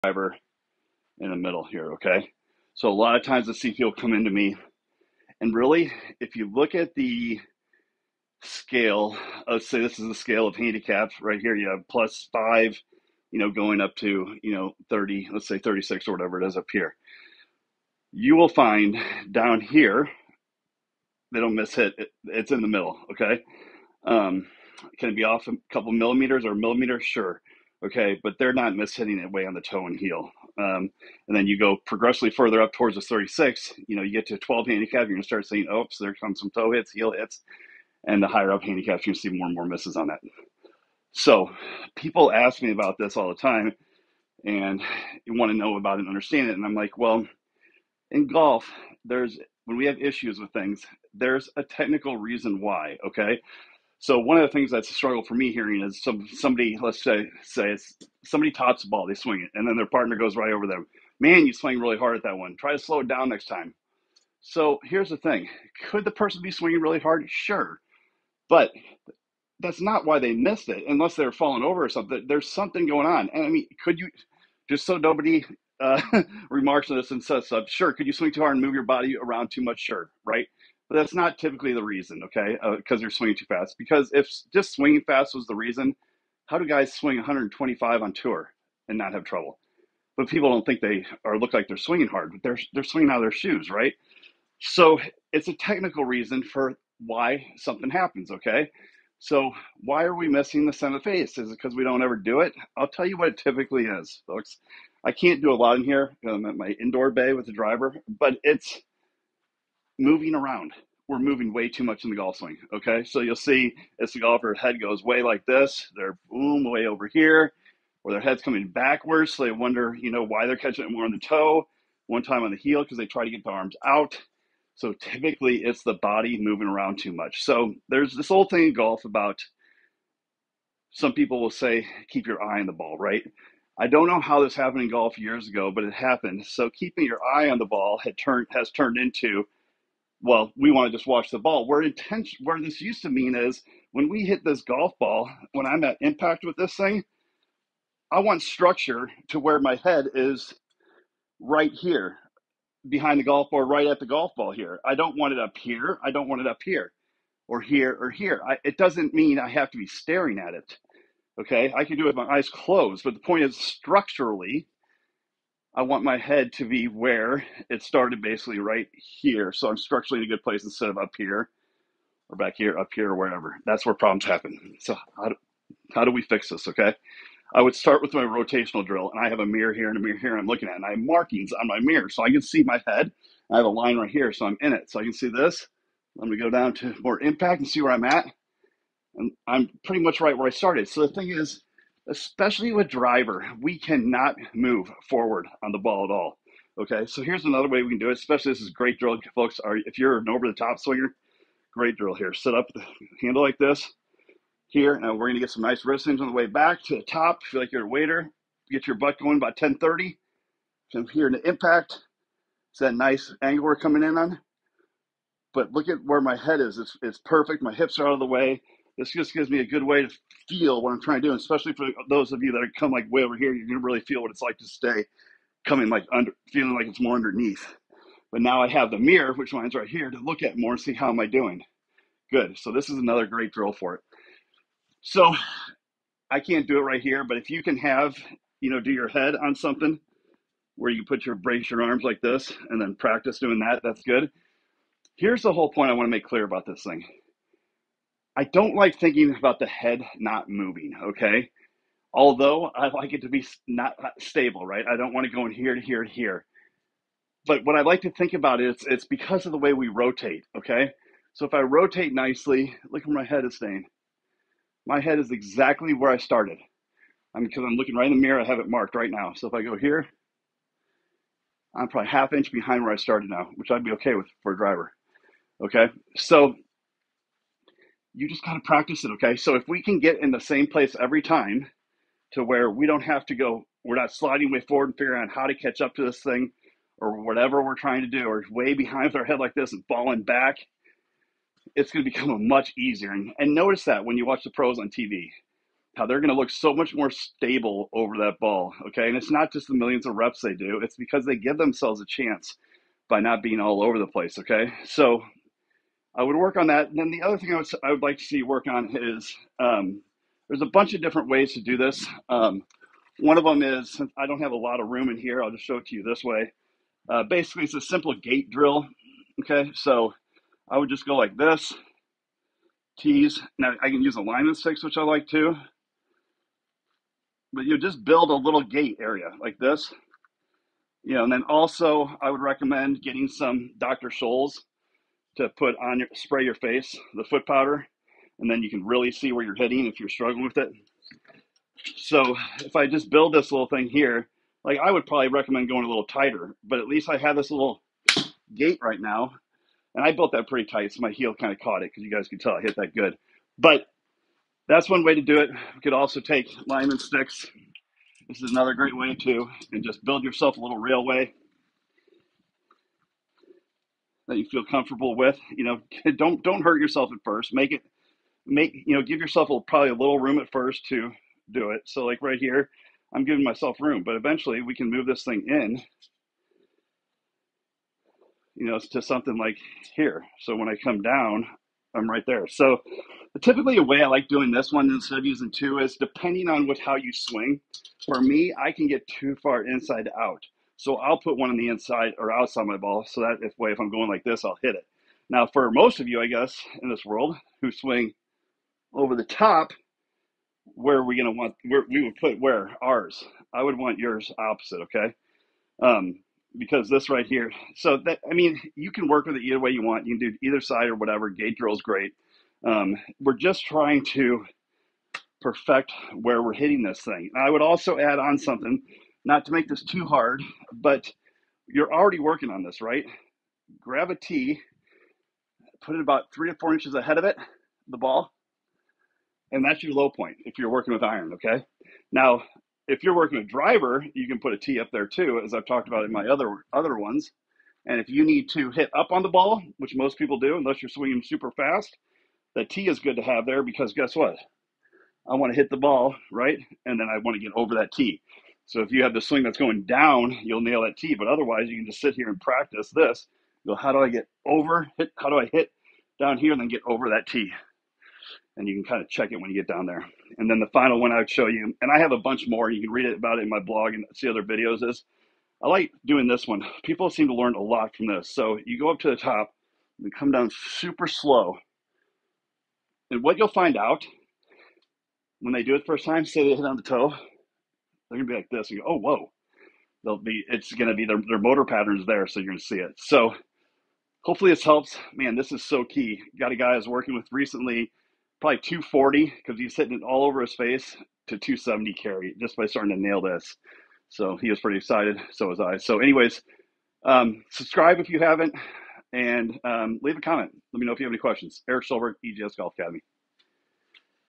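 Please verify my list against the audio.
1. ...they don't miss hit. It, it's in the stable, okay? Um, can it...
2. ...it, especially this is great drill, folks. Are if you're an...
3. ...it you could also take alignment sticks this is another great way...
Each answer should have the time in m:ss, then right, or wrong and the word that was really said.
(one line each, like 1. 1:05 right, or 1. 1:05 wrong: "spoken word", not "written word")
1. 0:21 wrong: "middle", not "stable"
2. 3:18 right
3. 5:55 right.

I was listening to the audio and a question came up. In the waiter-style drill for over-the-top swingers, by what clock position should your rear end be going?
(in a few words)
10:30.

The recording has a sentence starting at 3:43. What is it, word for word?
You're gonna really feel what it's like to stay coming like under, feeling like it's more underneath.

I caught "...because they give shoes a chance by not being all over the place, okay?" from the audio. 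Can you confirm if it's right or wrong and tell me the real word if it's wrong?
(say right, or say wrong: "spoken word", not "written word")
wrong: "themselves", not "shoes".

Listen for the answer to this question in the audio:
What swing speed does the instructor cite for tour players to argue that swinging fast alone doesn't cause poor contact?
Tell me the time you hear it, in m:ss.
1:27.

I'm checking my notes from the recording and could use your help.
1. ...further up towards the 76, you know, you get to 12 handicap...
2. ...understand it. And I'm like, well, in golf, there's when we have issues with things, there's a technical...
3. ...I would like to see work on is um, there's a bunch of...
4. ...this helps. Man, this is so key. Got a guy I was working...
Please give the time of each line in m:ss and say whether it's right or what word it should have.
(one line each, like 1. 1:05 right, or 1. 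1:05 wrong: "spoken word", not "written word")
1. 0:32 wrong: "36", not "76"
2. 0:46 right
3. 5:07 right
4. 8:04 right.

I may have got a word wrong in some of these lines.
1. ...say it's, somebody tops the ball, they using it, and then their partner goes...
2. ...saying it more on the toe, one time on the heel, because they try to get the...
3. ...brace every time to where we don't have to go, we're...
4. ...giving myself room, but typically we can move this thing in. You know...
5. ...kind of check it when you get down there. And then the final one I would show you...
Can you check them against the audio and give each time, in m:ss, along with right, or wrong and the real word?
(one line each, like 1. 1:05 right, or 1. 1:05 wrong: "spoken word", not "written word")
1. 0:57 wrong: "swing", not "using"
2. 2:00 wrong: "catching", not "saying"
3. 4:40 wrong: "place", not "brace"
4. 6:13 wrong: "eventually", not "typically"
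5. 7:38 right.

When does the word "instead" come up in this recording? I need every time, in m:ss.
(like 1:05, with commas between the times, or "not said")
2:50, 6:24.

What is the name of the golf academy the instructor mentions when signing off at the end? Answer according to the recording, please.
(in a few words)
EJS Golf Academy.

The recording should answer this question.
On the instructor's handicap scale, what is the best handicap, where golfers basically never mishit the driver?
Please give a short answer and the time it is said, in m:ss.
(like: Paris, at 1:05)
plus 5, at 0:11.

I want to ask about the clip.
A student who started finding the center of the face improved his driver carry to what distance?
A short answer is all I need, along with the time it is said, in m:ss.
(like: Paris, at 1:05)
270, at 8:11.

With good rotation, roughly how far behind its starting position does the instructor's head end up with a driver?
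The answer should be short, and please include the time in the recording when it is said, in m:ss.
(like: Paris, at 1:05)
half inch, at 4:32.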